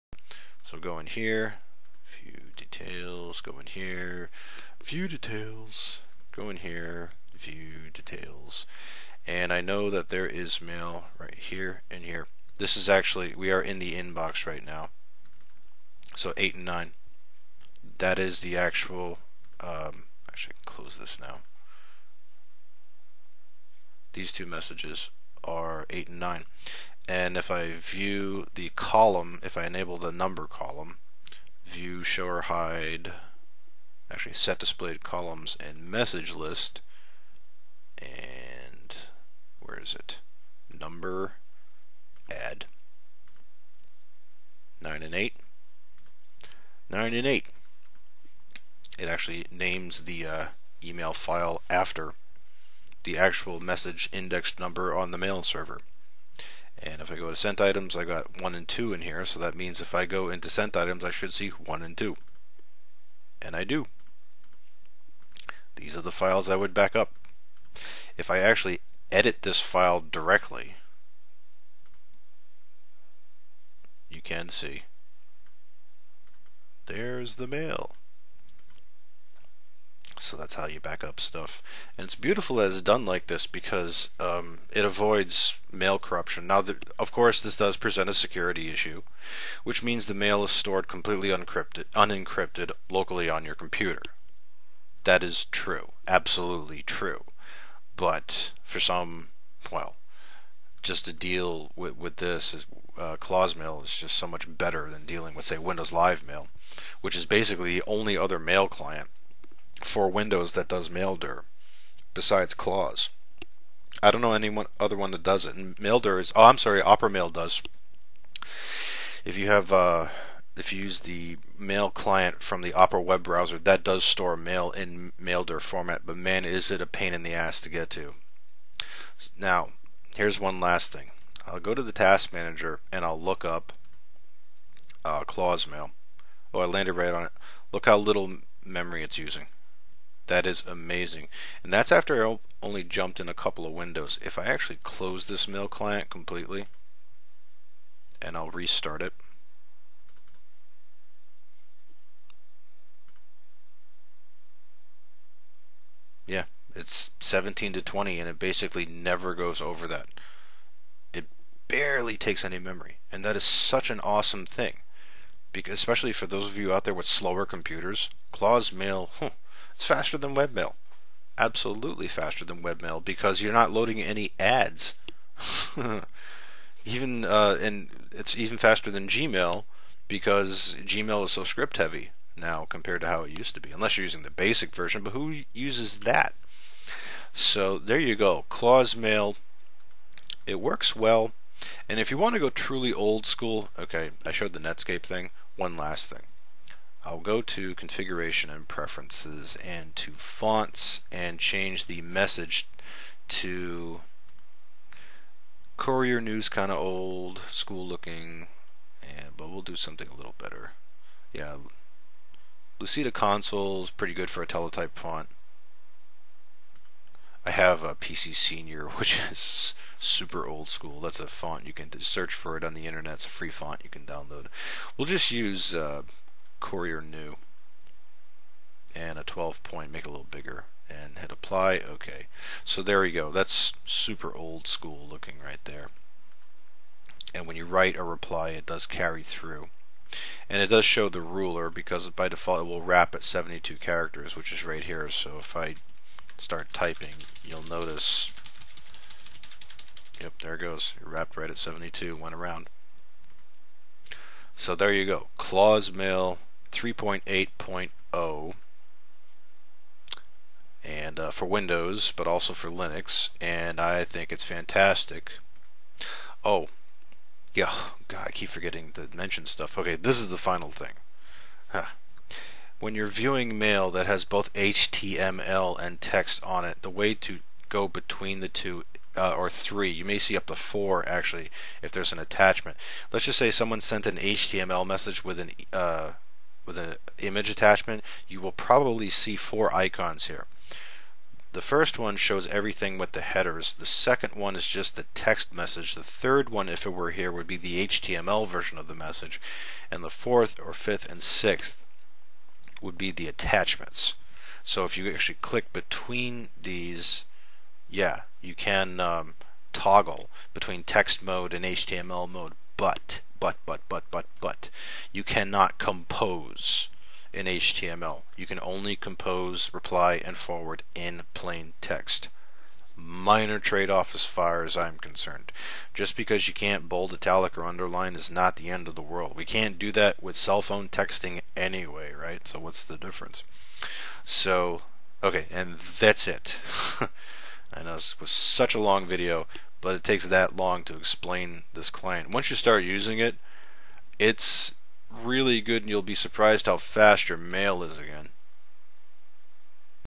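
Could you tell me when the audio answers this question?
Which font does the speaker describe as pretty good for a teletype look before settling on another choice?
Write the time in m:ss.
3:32.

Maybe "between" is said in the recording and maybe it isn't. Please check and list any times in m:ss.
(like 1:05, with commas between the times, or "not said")
4:37, 5:05, 5:10.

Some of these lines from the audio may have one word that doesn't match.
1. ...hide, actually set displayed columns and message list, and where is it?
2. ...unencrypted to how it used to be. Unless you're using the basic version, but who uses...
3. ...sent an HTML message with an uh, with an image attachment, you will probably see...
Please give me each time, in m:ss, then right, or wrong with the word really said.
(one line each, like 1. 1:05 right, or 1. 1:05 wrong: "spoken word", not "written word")
1. 0:32 right
2. 3:02 wrong: "compared", not "unencrypted"
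3. 4:43 right.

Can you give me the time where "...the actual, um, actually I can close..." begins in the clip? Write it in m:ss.
0:18.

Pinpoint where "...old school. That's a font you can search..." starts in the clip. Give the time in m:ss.
3:40.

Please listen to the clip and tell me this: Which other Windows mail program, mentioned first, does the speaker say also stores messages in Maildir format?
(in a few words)
Windows Live Mail.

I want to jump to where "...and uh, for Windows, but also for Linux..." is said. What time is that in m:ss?
4:20.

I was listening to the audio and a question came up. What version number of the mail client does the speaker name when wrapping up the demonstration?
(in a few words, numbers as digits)
3.8.0.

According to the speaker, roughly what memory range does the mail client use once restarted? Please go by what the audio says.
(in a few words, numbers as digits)
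17 to 20.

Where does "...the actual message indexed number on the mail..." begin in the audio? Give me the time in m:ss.
0:53.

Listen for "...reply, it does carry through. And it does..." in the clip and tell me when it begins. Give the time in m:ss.
3:58.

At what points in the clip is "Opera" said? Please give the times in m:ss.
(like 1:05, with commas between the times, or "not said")
1:56, 2:02.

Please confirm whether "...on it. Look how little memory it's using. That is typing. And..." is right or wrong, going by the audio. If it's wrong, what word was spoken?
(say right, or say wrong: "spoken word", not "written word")
wrong: "amazing", not "typing".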